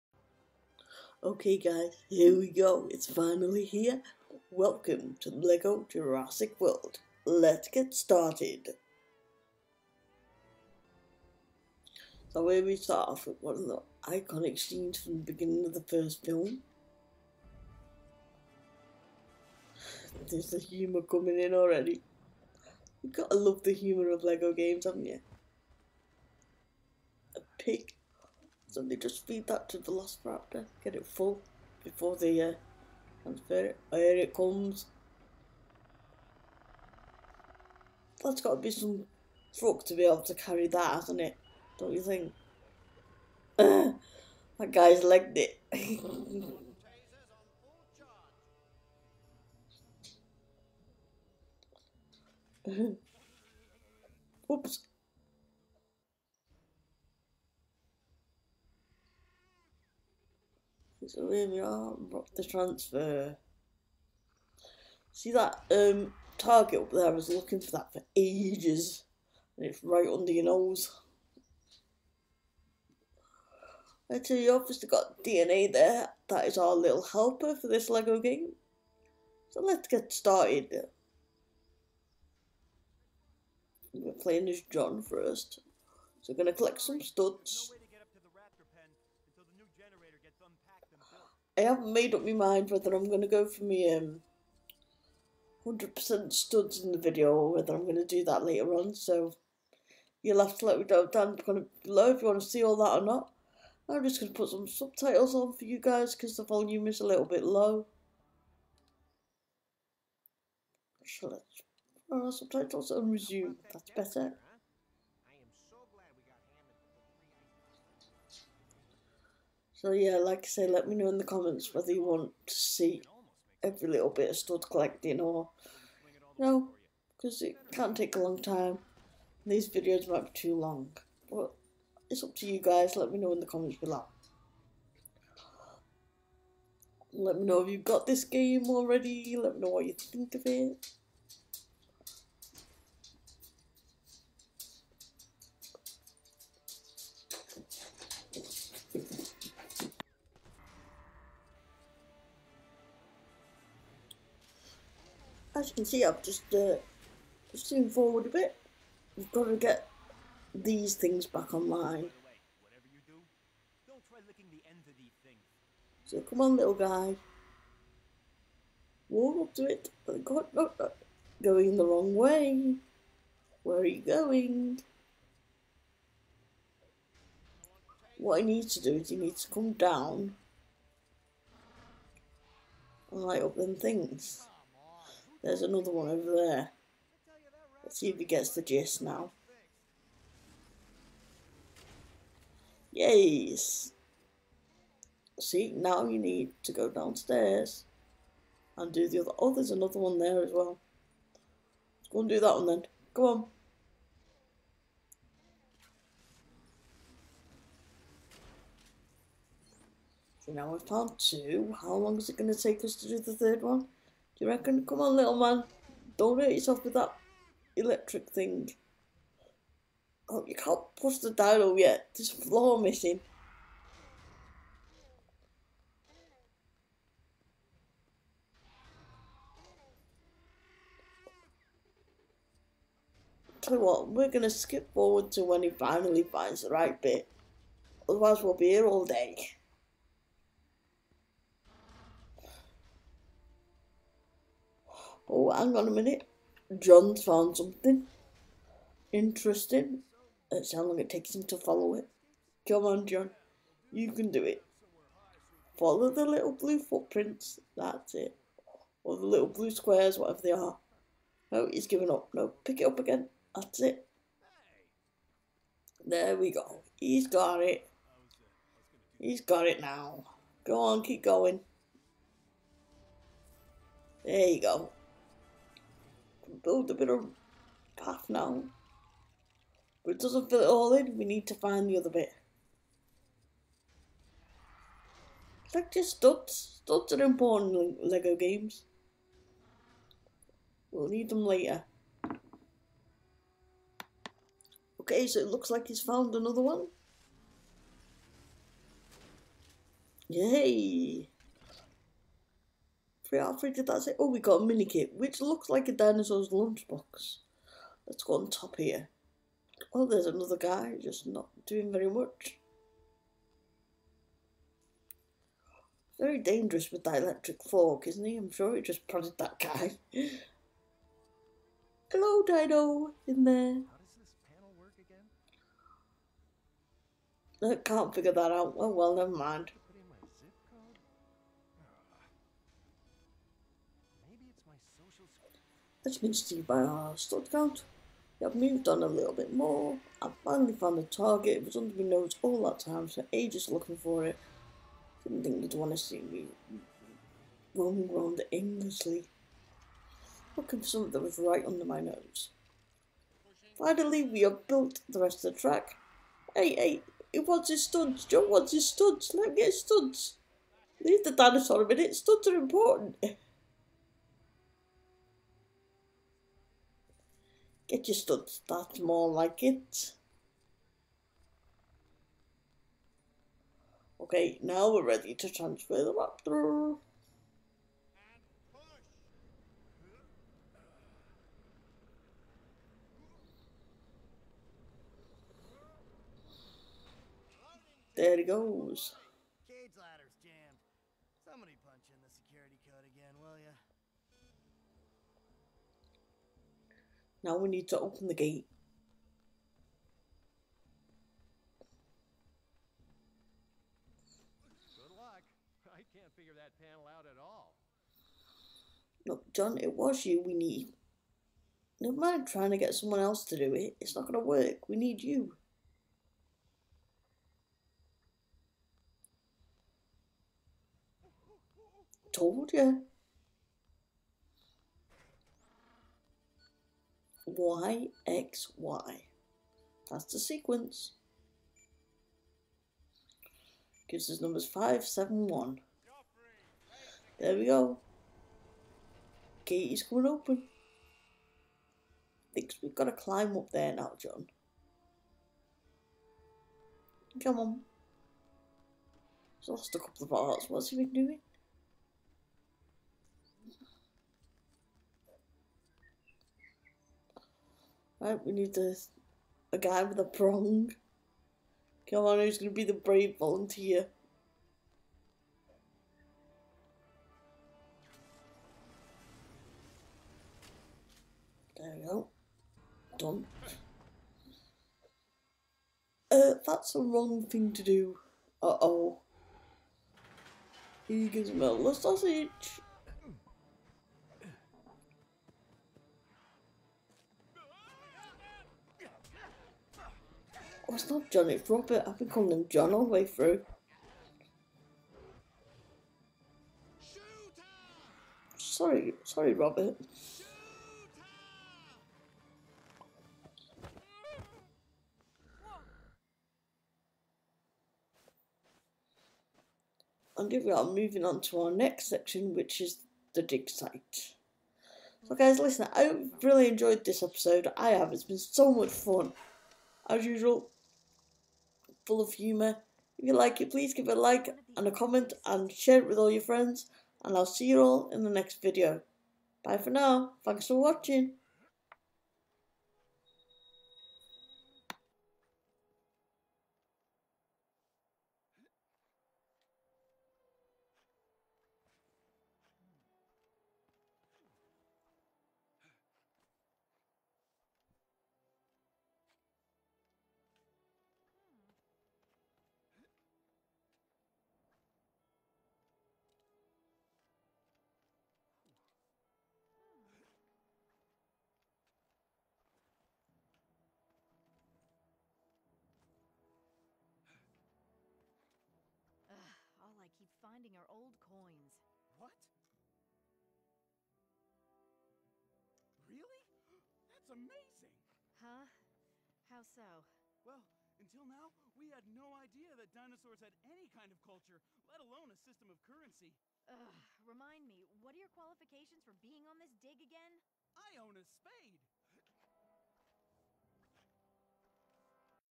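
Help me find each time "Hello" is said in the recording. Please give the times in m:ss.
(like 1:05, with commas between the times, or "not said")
5:22.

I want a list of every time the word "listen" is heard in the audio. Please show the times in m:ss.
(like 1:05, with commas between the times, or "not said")
8:35.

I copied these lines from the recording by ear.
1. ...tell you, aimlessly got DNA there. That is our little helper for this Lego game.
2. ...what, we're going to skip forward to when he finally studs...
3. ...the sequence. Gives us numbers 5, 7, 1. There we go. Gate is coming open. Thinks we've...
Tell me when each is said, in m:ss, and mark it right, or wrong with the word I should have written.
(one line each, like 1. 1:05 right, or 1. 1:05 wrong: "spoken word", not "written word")
1. 1:14 wrong: "obviously", not "aimlessly"
2. 3:53 wrong: "finds", not "studs"
3. 7:10 right.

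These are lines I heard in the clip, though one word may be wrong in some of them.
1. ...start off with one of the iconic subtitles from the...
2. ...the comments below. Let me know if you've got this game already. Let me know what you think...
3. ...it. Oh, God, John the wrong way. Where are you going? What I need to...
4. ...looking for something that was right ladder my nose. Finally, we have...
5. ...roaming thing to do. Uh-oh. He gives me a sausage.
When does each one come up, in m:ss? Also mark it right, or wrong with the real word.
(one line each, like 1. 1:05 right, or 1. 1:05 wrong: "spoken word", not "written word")
1. 0:12 wrong: "scenes", not "subtitles"
2. 2:13 right
3. 2:49 wrong: "Going", not "John"
4. 5:50 wrong: "under", not "ladder"
5. 7:56 wrong: "wrong", not "roaming".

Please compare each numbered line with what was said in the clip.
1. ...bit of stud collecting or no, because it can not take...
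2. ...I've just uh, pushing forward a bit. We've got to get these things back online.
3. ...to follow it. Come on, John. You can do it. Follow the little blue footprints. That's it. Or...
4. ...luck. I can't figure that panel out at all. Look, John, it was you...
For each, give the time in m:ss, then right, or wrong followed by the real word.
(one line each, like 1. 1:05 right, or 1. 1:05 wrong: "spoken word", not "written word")
1. 2:04 right
2. 2:36 right
3. 4:11 right
4. 6:45 right.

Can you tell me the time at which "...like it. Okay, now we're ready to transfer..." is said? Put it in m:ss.
6:09.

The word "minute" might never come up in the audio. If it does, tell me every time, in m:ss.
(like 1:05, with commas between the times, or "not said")
4:05, 6:01.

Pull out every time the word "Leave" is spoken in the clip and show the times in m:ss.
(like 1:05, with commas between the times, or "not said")
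6:01.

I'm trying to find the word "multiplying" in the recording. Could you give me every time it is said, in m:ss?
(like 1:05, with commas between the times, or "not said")
not said.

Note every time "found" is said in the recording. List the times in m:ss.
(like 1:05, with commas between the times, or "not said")
3:30, 4:07, 4:56, 5:40.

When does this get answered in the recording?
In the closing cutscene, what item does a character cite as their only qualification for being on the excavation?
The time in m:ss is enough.
9:50.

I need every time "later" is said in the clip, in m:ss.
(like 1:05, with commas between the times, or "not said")
1:38, 4:51.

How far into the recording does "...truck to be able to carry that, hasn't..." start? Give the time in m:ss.
0:39.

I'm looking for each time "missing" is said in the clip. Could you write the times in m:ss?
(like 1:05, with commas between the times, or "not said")
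3:42.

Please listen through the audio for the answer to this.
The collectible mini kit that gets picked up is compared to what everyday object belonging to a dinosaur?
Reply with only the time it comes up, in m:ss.
5:05.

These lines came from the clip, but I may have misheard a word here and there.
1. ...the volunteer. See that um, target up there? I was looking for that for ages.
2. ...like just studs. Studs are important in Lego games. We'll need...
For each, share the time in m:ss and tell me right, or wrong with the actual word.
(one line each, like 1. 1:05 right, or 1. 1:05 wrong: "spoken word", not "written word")
1. 1:02 wrong: "transfer", not "volunteer"
2. 4:45 right.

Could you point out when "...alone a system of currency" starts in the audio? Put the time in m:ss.
9:45.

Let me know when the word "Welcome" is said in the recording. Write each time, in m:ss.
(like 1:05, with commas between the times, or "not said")
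0:04.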